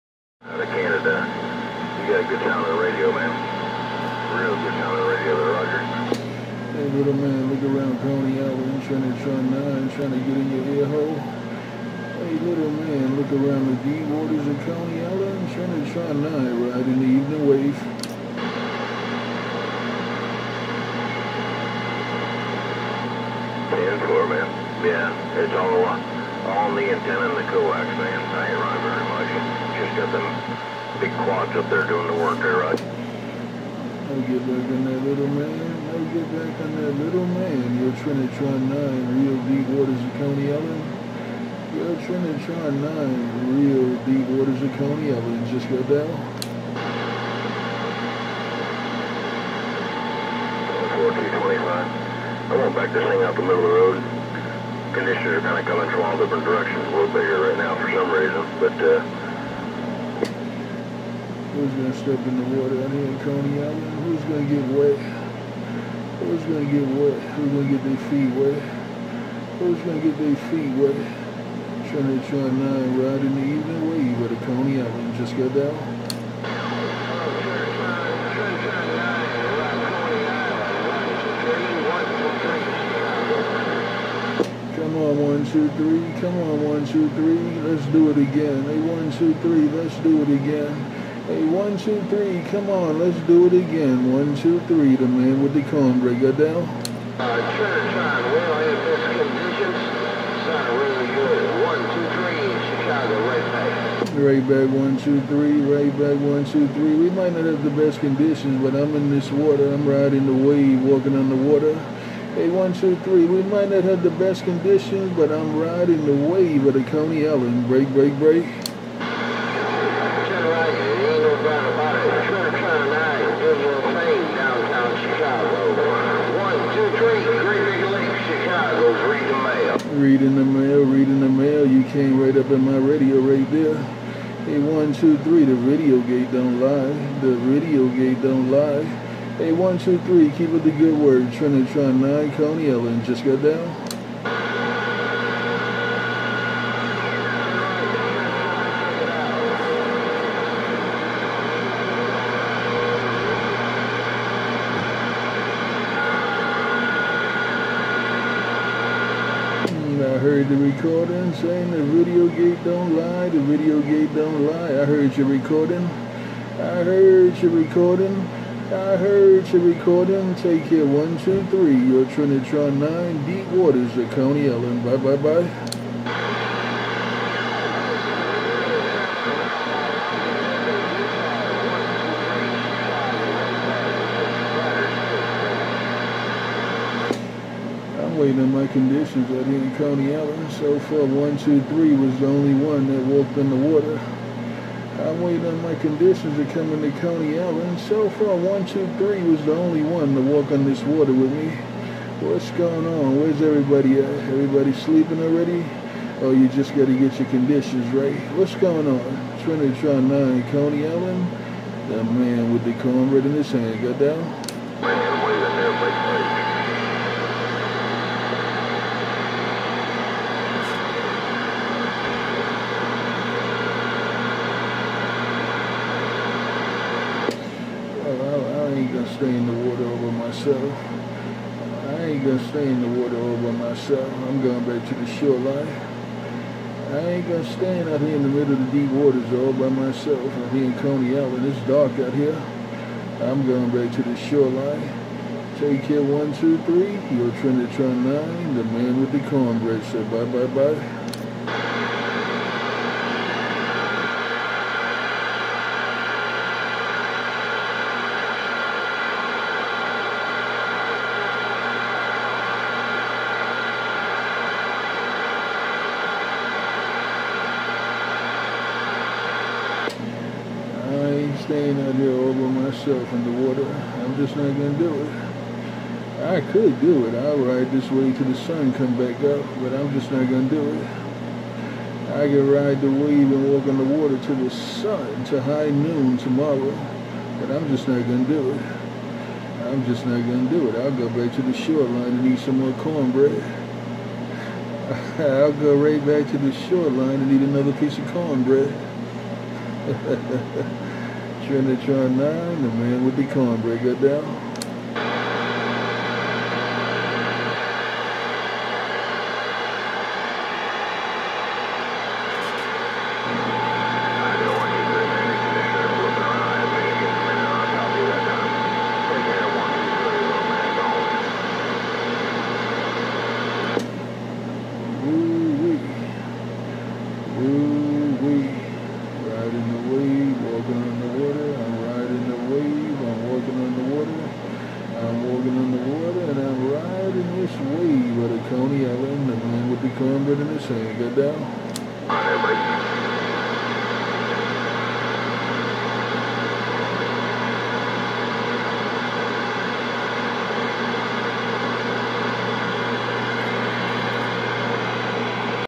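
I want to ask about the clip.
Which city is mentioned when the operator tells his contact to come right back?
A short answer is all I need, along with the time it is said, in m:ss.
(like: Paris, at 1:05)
Chicago, at 1:42.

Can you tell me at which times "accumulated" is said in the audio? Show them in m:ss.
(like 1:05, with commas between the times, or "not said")
not said.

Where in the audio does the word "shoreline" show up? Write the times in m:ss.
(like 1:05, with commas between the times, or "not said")
3:55, 4:04, 4:51, 4:56.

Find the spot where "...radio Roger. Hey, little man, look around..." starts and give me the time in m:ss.
0:05.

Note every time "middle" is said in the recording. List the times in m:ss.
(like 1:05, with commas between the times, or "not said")
0:53, 3:58.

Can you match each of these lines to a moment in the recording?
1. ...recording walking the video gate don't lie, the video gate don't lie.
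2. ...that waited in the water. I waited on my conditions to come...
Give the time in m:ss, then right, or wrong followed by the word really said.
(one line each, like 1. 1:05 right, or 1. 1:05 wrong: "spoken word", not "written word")
1. 2:40 wrong: "saying", not "walking"
2. 3:12 wrong: "walked", not "waited".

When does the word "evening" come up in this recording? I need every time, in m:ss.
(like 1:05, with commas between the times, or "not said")
0:17, 1:13.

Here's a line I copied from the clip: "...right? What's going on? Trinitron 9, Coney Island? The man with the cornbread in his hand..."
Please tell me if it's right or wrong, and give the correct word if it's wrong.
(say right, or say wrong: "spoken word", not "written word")
right.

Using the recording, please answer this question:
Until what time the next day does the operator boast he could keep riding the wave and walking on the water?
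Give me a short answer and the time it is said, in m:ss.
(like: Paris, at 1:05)
high noon, at 4:45.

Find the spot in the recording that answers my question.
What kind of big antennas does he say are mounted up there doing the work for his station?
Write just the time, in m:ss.
0:31.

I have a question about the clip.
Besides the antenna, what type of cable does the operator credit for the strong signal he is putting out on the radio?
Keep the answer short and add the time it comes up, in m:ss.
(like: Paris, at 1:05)
coax, at 0:27.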